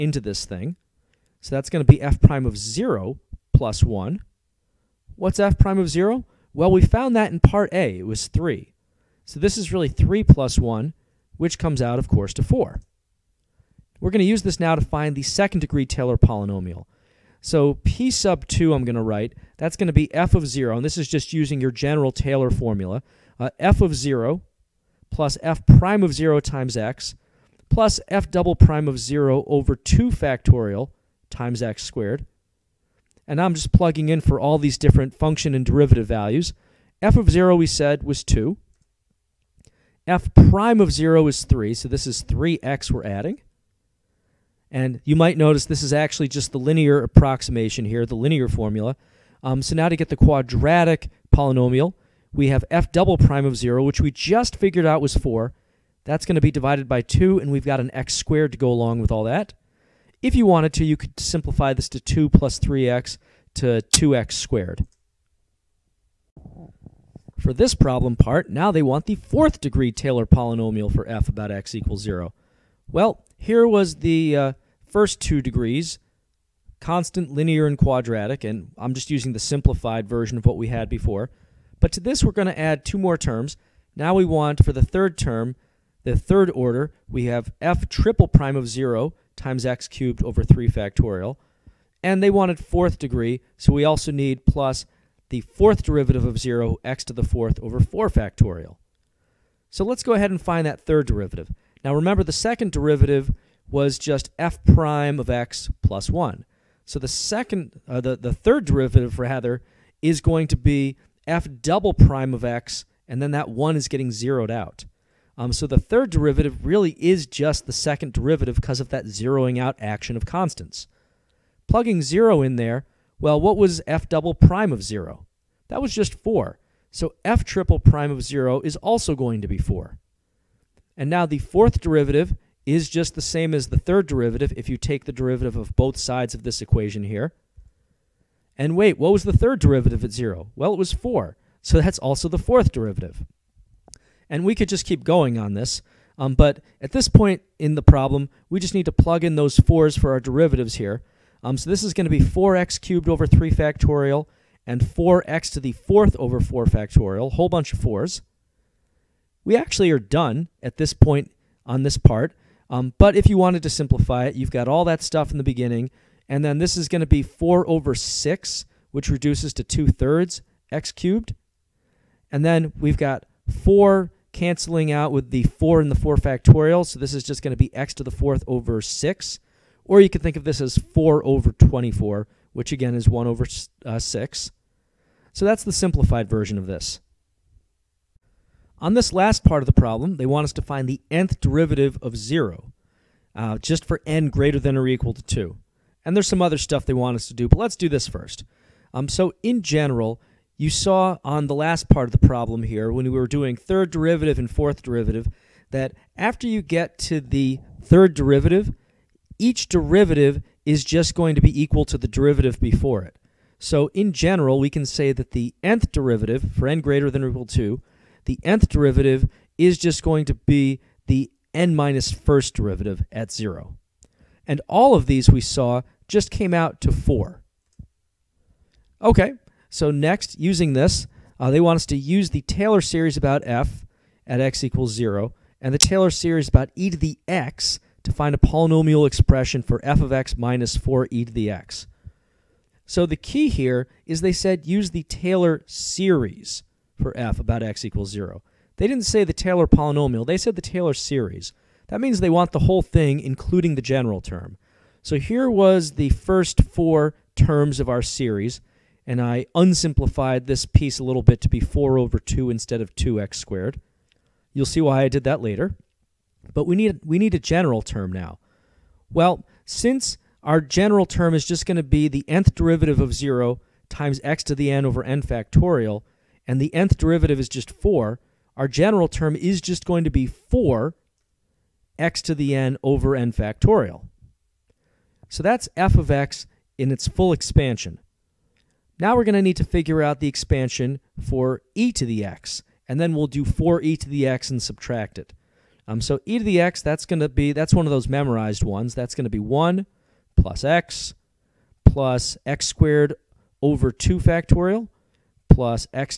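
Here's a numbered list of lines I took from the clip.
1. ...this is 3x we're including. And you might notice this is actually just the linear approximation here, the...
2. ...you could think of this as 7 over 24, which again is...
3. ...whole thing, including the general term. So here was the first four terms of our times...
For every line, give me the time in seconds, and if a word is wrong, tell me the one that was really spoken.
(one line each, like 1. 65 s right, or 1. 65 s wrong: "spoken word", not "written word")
1. 41 s wrong: "adding", not "including"
2. 180 s wrong: "4", not "7"
3. 252 s wrong: "series", not "times".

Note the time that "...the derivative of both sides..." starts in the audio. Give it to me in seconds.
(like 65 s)
135 s.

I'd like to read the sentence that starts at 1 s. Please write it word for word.
So that's going to be f prime of 0 plus 1.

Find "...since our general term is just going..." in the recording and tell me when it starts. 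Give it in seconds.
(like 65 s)
269 s.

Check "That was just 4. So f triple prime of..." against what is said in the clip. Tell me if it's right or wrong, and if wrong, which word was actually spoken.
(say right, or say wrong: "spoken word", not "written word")
right.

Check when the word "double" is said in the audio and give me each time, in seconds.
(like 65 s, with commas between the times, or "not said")
28 s, 52 s, 111 s, 124 s.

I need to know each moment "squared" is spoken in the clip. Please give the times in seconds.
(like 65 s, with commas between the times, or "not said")
31 s, 58 s, 64 s, 263 s, 302 s.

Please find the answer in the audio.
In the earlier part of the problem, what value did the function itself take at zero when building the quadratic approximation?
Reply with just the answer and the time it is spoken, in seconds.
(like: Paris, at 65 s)
2, at 37 s.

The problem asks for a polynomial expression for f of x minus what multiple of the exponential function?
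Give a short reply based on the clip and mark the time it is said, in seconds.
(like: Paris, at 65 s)
4e^x, at 240 s.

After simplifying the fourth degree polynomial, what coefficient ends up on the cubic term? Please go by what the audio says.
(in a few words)
2/3.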